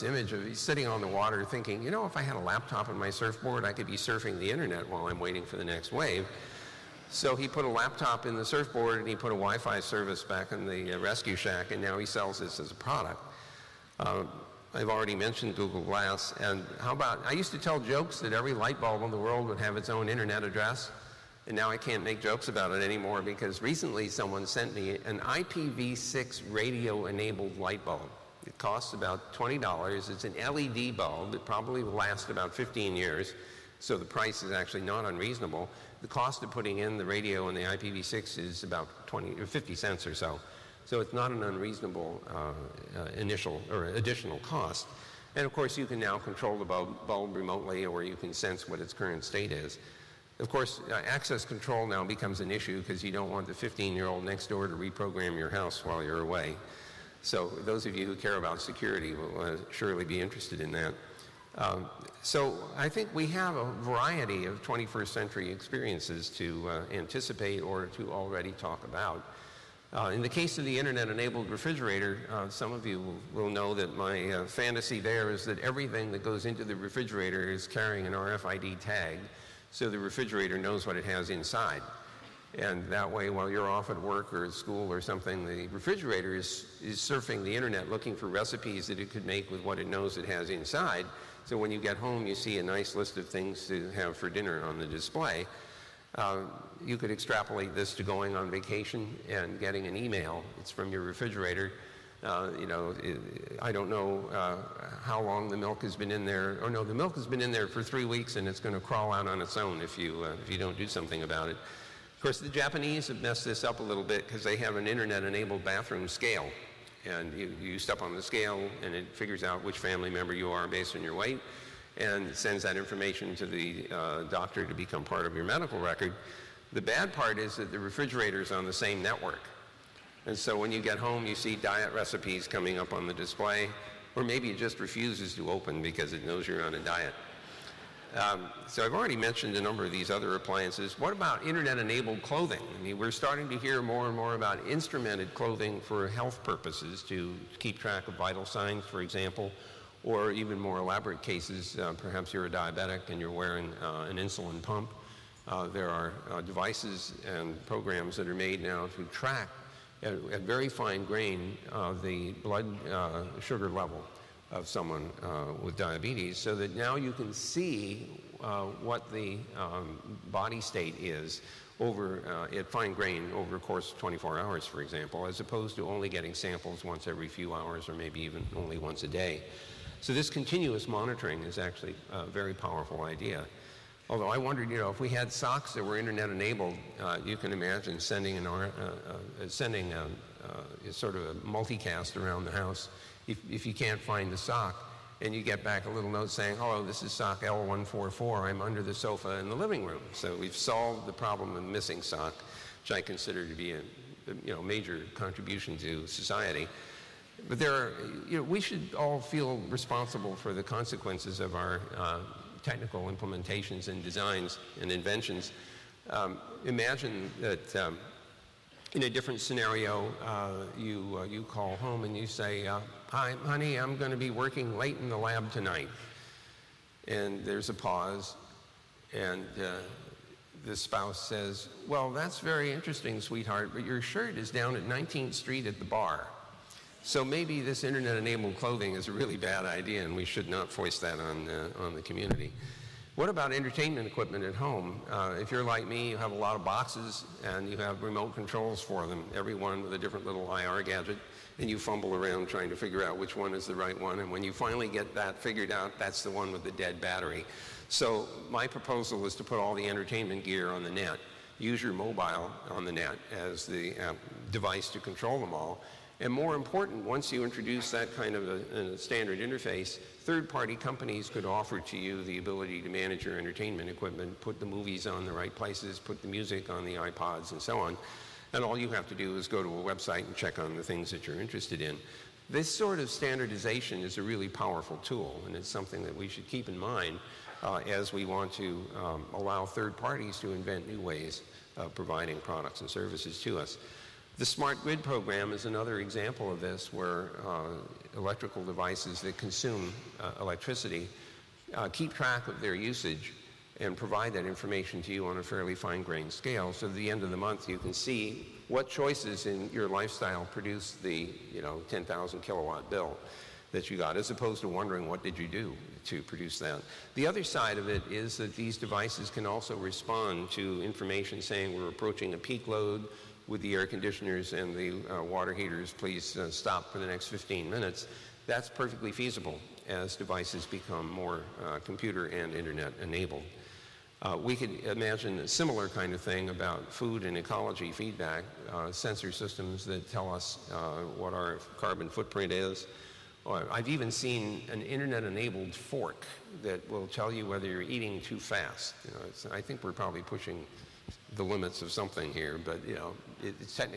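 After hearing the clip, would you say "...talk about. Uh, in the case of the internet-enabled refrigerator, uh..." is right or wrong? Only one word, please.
right.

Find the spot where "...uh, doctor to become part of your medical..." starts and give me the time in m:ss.
2:03.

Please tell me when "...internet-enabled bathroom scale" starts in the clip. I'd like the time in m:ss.
1:54.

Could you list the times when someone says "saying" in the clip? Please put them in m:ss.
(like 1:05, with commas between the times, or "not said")
3:16, 5:21.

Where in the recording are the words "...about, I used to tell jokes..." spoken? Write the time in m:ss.
0:16.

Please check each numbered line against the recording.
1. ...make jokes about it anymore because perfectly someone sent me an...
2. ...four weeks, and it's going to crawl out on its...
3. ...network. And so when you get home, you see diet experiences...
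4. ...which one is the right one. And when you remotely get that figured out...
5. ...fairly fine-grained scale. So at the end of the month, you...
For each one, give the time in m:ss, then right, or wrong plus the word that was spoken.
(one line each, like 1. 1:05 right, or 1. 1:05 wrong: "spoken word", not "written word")
1. 0:22 wrong: "recently", not "perfectly"
2. 1:47 wrong: "three", not "four"
3. 2:09 wrong: "recipes", not "experiences"
4. 4:13 wrong: "finally", not "remotely"
5. 5:05 right.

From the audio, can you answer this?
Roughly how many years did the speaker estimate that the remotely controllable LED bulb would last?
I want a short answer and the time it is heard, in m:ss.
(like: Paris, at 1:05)
15 years, at 0:32.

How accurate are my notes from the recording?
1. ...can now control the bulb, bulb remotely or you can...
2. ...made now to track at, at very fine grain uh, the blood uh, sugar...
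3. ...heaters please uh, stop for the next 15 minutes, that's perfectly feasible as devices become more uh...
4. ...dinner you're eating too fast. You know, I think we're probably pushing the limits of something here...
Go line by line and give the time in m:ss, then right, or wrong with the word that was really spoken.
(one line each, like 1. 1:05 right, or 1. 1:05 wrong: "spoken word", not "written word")
1. 0:45 right
2. 2:38 right
3. 5:25 right
4. 5:47 wrong: "whether", not "dinner".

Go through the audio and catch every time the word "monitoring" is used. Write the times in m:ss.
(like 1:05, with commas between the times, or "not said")
3:00.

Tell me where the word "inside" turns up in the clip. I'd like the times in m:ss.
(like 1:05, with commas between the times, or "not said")
1:21, 1:30.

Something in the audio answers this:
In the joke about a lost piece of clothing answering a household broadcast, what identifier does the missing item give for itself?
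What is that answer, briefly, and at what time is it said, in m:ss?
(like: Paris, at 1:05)
L144, at 3:17.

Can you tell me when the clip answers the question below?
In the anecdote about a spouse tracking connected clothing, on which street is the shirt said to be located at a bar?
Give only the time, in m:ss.
3:54.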